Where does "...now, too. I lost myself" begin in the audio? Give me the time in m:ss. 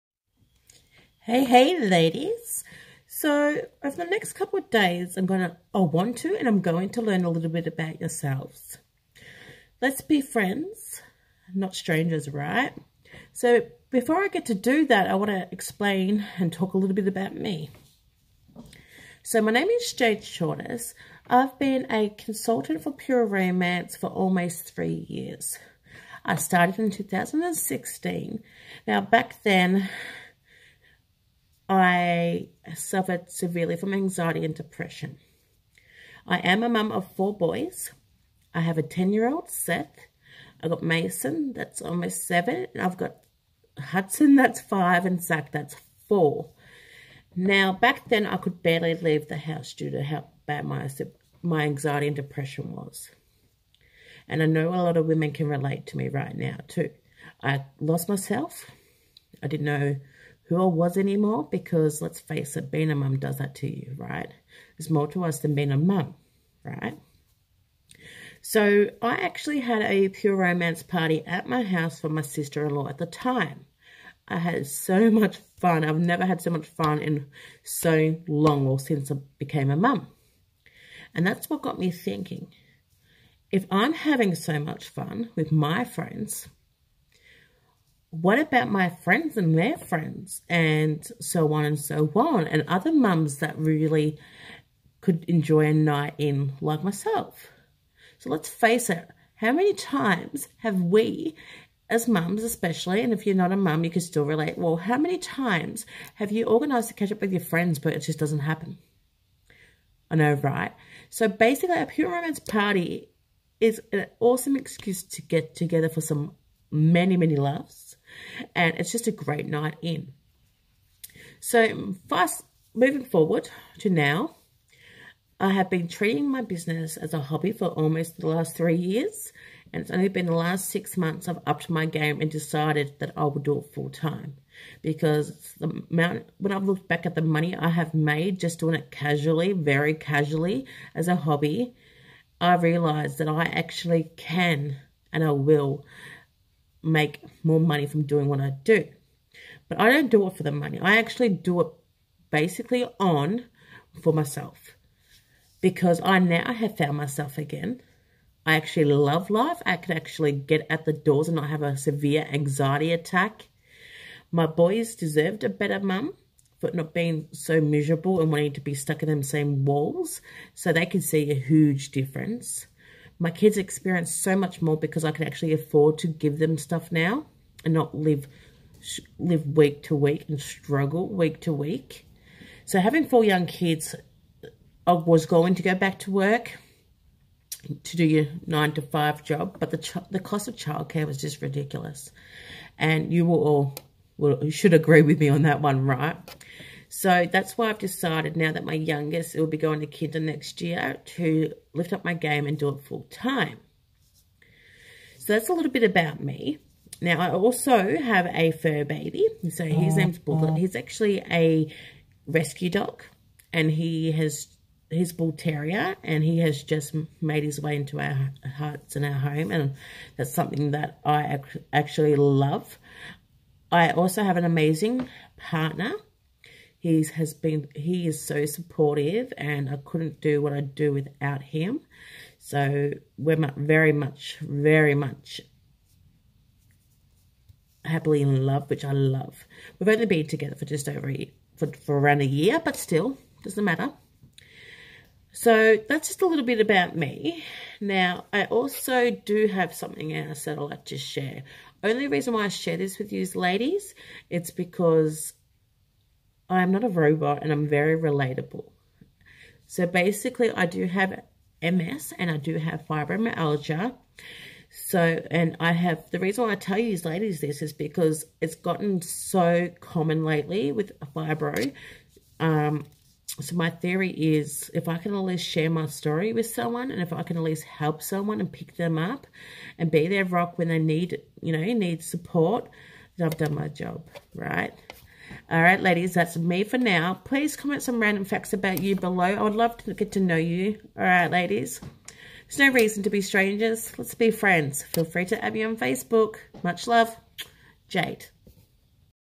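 0:56.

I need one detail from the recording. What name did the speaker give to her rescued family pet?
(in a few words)
Bullet.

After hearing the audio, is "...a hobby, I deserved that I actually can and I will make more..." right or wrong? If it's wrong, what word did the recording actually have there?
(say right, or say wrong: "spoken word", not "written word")
wrong: "realized", not "deserved".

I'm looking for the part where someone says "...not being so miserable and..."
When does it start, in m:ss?
2:46.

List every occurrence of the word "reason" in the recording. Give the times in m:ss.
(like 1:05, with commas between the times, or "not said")
4:12, 4:26, 4:52.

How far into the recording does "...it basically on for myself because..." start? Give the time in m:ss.
2:31.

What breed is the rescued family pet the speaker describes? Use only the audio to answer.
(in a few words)
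Bull terrier.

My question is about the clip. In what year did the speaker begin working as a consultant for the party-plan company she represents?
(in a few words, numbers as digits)
2016.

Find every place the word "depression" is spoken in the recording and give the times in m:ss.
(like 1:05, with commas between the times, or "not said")
0:34, 0:52.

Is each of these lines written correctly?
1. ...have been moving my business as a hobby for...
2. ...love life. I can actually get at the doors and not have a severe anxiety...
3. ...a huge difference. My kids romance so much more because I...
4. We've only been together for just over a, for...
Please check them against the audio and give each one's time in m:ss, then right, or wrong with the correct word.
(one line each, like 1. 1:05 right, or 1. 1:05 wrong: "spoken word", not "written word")
1. 2:05 wrong: "treating", not "moving"
2. 2:38 right
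3. 2:51 wrong: "experience", not "romance"
4. 3:59 right.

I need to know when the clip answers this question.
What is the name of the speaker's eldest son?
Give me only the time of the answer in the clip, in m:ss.
0:39.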